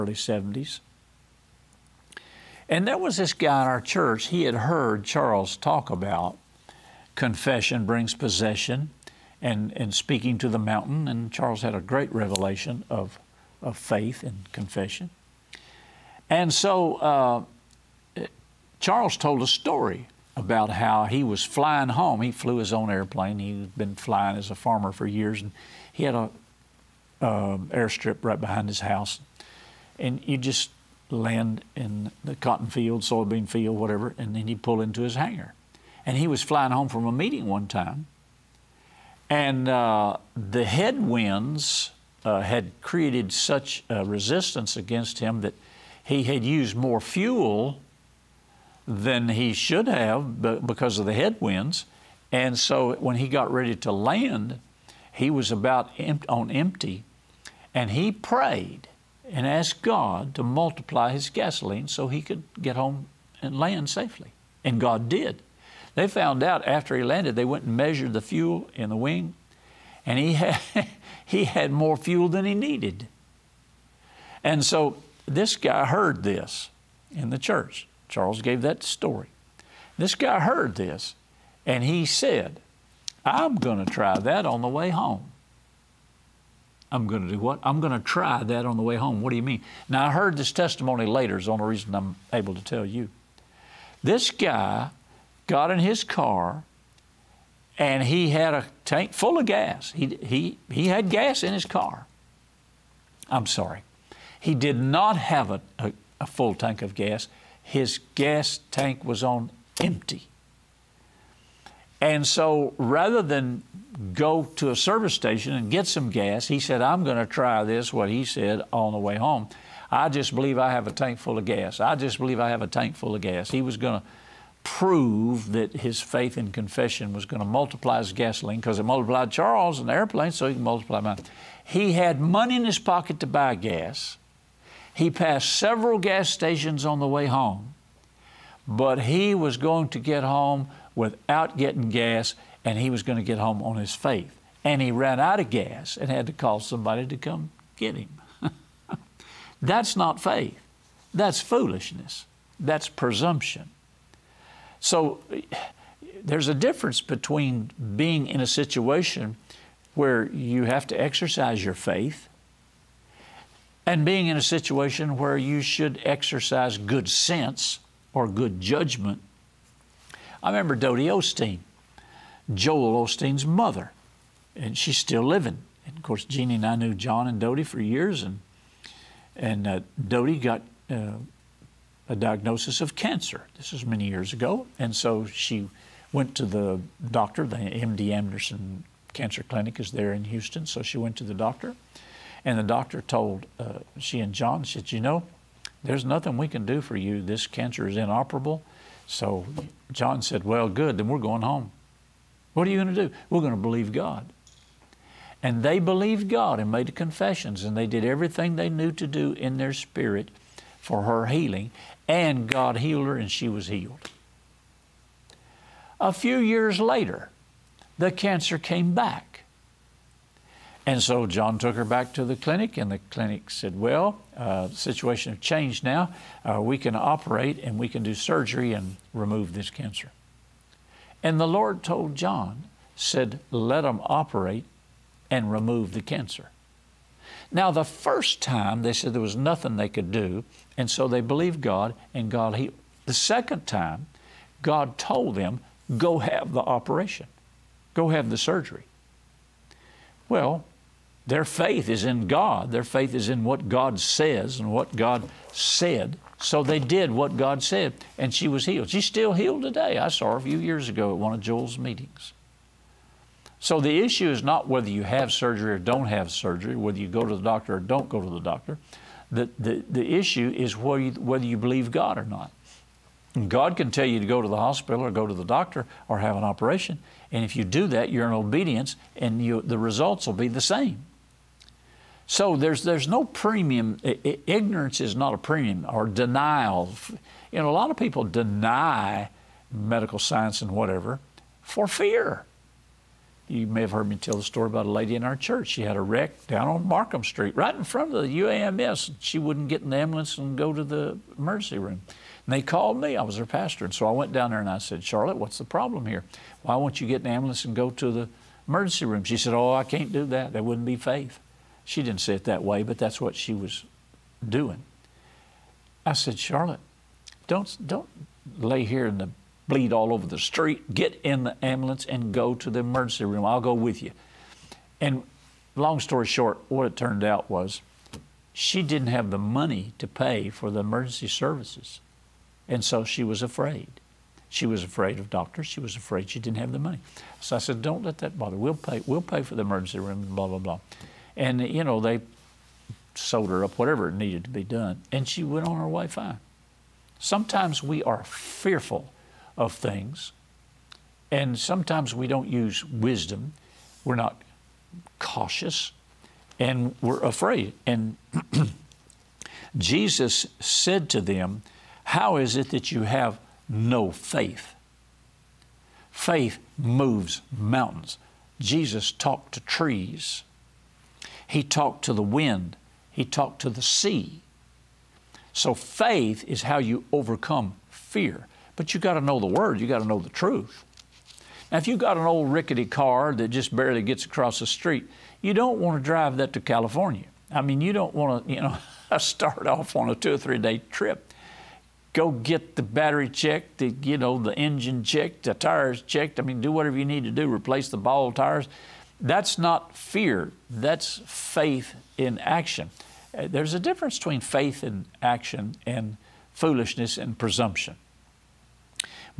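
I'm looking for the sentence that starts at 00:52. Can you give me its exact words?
And so when he got ready to land, he was about on empty.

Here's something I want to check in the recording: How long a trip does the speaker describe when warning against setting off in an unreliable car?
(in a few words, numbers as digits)
2 or 3 days.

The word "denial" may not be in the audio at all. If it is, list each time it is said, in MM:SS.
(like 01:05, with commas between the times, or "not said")
04:46.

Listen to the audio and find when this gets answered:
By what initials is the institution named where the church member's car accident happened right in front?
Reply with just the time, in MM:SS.
04:58.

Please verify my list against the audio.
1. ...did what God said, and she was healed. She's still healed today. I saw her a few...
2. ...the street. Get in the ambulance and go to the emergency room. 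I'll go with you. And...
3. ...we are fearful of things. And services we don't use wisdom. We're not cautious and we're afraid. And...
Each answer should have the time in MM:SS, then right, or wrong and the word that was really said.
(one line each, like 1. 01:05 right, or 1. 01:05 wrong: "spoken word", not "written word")
1. 04:16 right
2. 05:20 right
3. 05:47 wrong: "sometimes", not "services".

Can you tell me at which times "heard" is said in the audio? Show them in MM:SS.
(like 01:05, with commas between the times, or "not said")
00:04, 01:15, 01:20, 01:30, 04:53.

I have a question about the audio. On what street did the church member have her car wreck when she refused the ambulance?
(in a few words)
Markham Street.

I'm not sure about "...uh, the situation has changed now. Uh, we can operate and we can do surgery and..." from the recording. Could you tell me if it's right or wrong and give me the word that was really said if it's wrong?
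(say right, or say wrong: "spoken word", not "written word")
right.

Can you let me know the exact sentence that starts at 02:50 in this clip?
I remember Dodie Osteen, Joel Osteen's mother, and she's still living.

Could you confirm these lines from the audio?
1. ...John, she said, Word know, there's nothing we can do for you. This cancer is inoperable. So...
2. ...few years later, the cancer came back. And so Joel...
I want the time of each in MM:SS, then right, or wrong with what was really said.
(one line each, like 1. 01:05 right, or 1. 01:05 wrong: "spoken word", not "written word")
1. 03:14 wrong: "You", not "Word"
2. 03:36 wrong: "John", not "Joel".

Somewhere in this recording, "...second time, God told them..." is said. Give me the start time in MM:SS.
04:03.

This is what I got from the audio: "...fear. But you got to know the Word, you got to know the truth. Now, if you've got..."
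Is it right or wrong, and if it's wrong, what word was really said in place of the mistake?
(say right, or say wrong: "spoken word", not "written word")
right.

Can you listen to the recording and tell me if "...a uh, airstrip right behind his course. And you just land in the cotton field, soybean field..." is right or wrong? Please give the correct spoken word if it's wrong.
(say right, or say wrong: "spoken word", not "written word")
wrong: "house", not "course".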